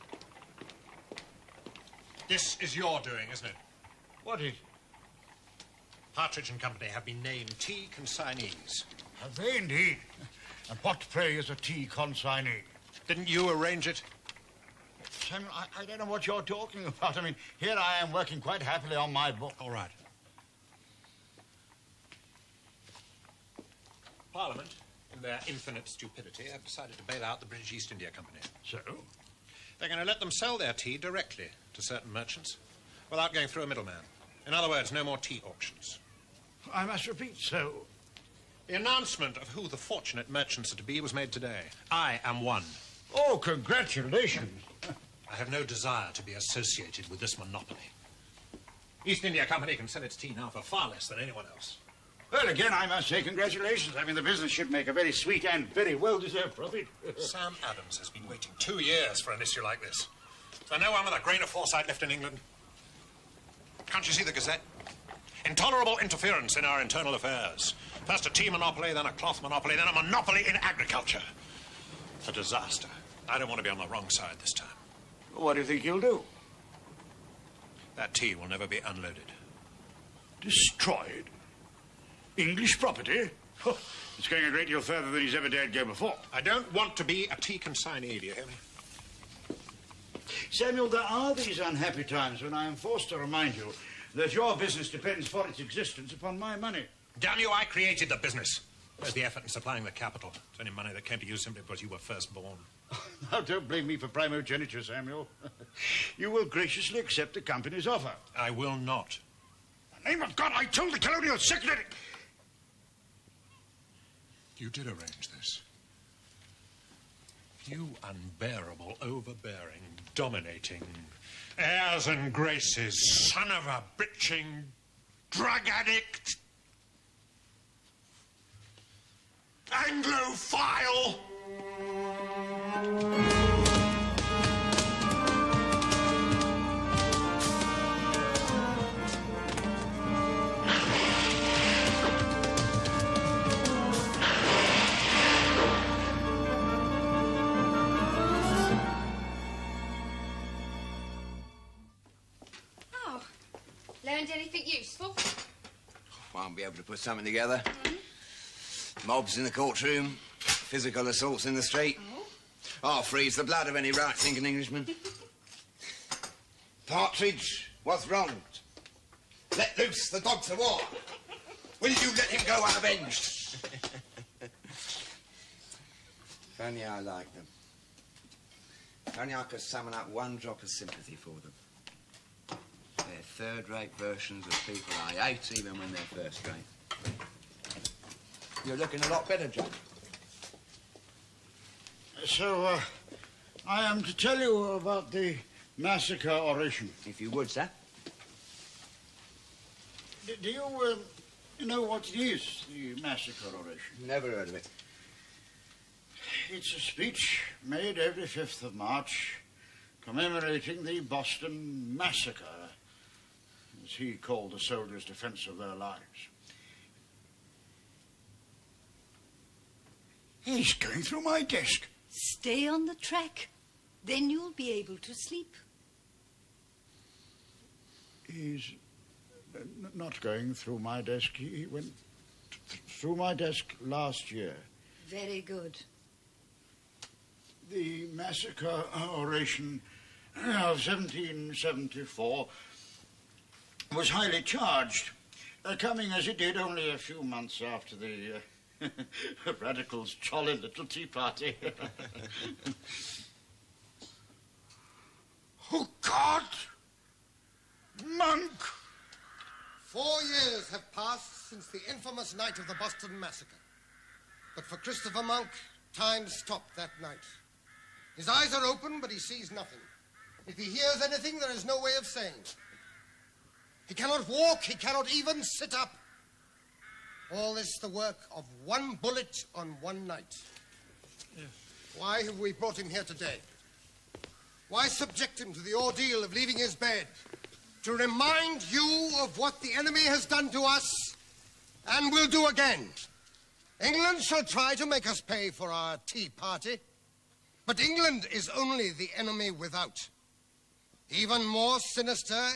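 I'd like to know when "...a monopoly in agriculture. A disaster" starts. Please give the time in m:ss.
1:09.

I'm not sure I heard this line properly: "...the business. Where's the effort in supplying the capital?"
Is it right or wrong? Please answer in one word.
right.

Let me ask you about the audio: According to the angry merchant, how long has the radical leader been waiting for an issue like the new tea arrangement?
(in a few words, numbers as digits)
2 years.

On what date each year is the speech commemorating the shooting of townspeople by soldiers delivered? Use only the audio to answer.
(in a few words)
5 March.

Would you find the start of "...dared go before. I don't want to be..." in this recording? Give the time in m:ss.
1:25.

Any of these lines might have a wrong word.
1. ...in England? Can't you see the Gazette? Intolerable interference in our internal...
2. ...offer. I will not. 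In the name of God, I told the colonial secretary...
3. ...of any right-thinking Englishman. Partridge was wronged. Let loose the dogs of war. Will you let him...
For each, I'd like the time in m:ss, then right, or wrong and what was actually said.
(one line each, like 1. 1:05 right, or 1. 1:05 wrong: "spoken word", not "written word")
1. 1:02 right
2. 1:47 right
3. 2:43 right.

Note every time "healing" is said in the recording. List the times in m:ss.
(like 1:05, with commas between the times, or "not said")
not said.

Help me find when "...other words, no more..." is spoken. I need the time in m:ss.
0:34.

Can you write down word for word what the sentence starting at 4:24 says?
But for Christopher Monk, time stopped that night.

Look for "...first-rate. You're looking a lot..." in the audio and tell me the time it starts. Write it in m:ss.
3:06.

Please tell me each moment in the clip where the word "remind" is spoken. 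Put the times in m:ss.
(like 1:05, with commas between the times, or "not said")
1:33, 4:47.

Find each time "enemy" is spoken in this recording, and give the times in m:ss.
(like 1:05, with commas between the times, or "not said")
4:49, 4:59.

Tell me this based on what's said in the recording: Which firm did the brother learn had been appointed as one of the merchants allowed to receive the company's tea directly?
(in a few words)
Partridge and Company.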